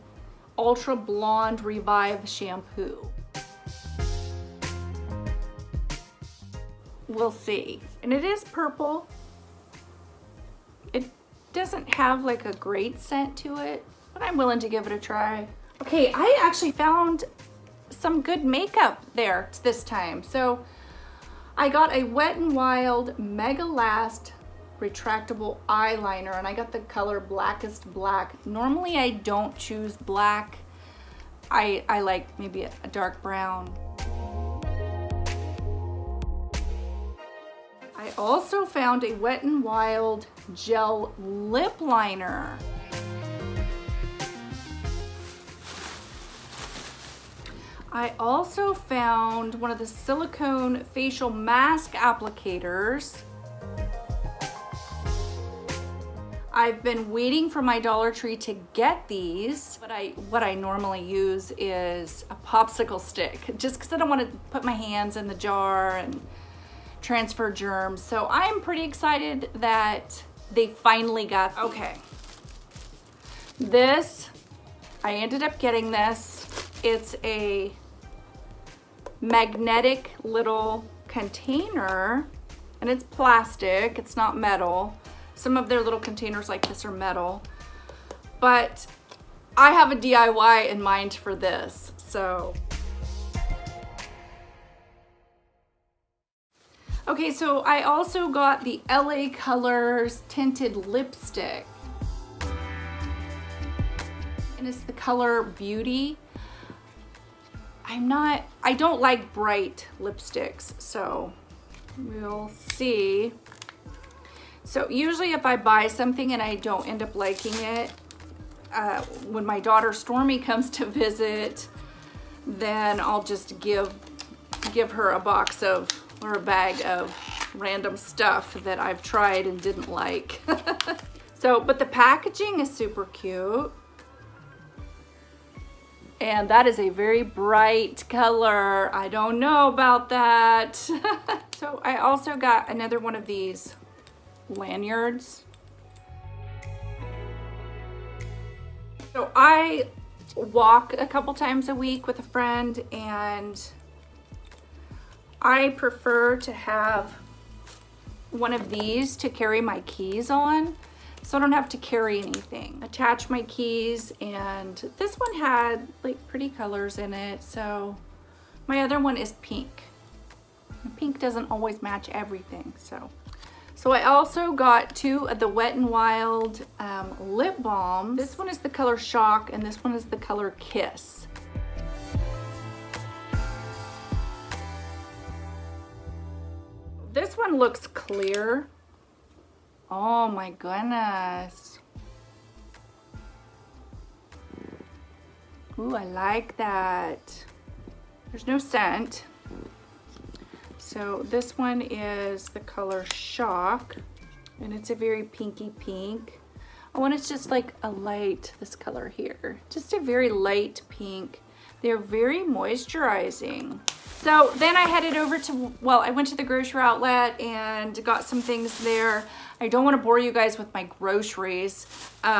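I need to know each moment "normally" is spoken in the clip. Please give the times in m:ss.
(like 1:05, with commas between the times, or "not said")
0:28, 1:00.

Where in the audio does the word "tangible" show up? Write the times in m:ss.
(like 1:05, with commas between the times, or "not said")
not said.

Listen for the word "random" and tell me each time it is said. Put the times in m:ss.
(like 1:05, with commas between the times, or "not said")
2:07.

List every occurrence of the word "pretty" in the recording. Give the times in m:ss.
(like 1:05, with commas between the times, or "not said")
1:08, 2:46.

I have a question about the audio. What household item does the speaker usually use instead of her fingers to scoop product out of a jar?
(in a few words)
Popsicle stick.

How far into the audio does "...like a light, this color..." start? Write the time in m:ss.
3:27.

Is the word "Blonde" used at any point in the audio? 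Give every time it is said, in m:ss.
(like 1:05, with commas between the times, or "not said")
0:00.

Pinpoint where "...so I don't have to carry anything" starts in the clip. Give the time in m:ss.
2:41.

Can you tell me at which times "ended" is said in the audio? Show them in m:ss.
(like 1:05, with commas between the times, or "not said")
1:15.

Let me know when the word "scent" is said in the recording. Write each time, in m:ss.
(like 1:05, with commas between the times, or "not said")
0:12, 3:18.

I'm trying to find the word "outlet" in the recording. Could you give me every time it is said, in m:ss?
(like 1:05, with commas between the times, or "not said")
3:36.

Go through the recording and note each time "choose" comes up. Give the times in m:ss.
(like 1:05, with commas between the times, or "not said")
0:29.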